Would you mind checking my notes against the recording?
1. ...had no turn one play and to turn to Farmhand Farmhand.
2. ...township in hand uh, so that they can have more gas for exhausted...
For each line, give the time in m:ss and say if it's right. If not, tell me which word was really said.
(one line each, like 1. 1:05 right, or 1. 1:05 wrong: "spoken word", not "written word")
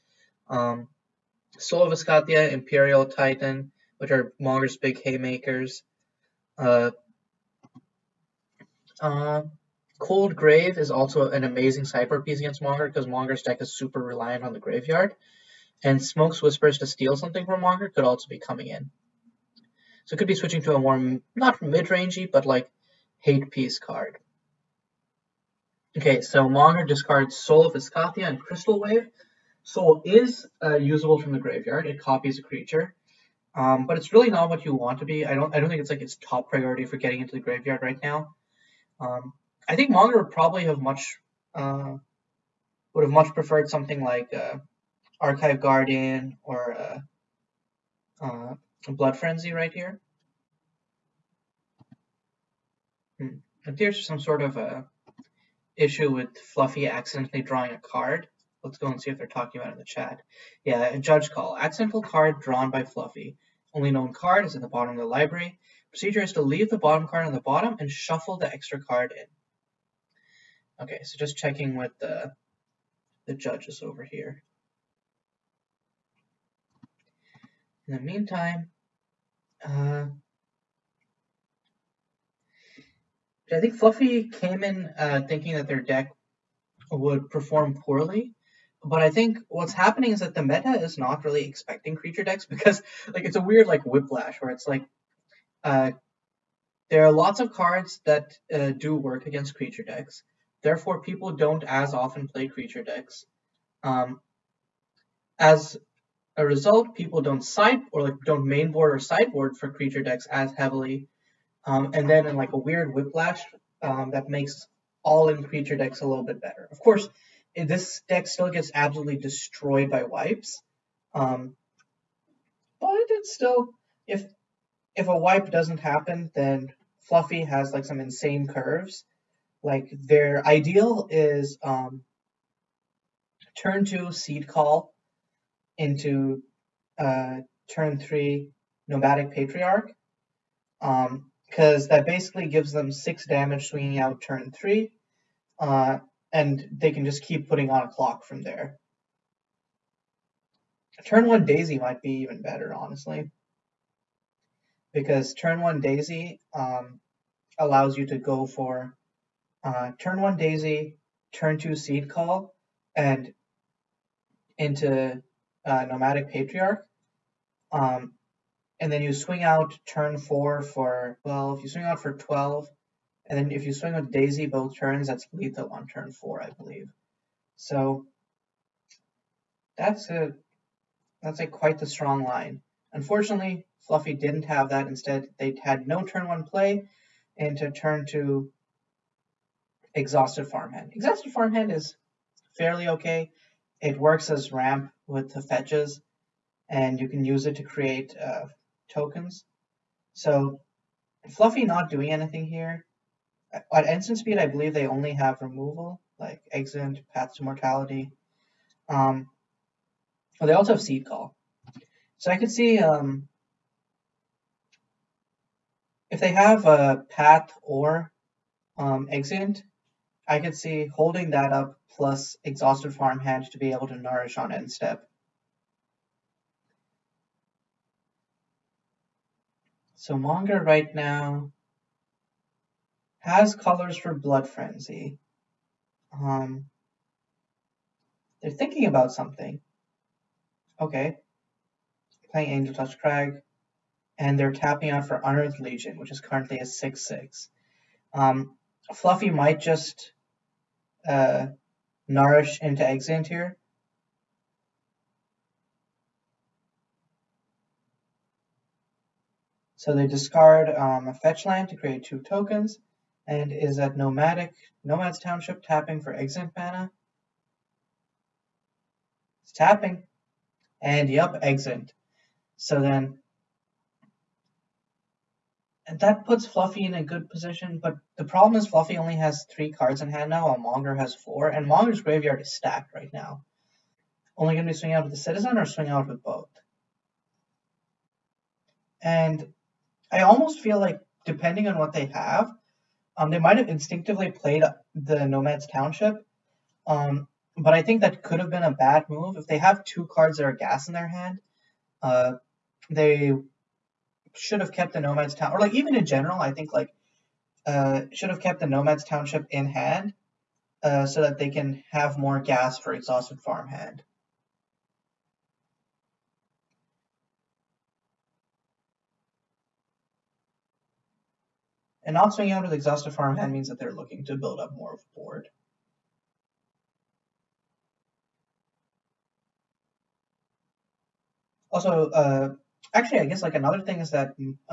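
1. 3:05 wrong: "Exhausted", not "Farmhand"
2. 5:09 right.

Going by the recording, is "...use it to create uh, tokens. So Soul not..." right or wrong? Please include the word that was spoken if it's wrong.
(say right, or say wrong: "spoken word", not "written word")
wrong: "Fluffy", not "Soul".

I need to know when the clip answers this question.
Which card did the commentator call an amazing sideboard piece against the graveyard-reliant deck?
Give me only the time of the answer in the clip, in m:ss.
0:09.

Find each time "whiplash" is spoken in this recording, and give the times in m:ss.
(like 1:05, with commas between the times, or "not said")
1:33, 1:52.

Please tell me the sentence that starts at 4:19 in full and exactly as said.
So they discard um, a fetch land to create two tokens, and is at nomadic nomad's township tapping for exant mana.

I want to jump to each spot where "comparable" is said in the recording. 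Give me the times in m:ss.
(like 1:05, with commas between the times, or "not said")
not said.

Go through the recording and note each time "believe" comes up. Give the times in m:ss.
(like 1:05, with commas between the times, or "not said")
2:56, 3:24.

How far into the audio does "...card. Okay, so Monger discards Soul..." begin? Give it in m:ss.
0:23.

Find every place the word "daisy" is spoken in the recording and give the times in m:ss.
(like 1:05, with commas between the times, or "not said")
2:31, 2:35, 2:40, 2:54.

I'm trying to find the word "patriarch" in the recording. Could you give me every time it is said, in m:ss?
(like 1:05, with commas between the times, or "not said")
2:19, 2:46.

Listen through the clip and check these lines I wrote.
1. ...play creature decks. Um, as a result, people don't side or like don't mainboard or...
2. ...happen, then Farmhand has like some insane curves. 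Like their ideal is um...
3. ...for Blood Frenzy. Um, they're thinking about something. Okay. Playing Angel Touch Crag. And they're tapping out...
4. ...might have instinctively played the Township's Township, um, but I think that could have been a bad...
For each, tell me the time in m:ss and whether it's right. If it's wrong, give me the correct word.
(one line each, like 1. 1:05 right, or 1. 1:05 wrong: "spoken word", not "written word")
1. 1:42 right
2. 2:05 wrong: "Fluffy", not "Farmhand"
3. 3:53 right
4. 4:53 wrong: "Nomad", not "Township".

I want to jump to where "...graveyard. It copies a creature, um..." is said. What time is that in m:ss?
0:31.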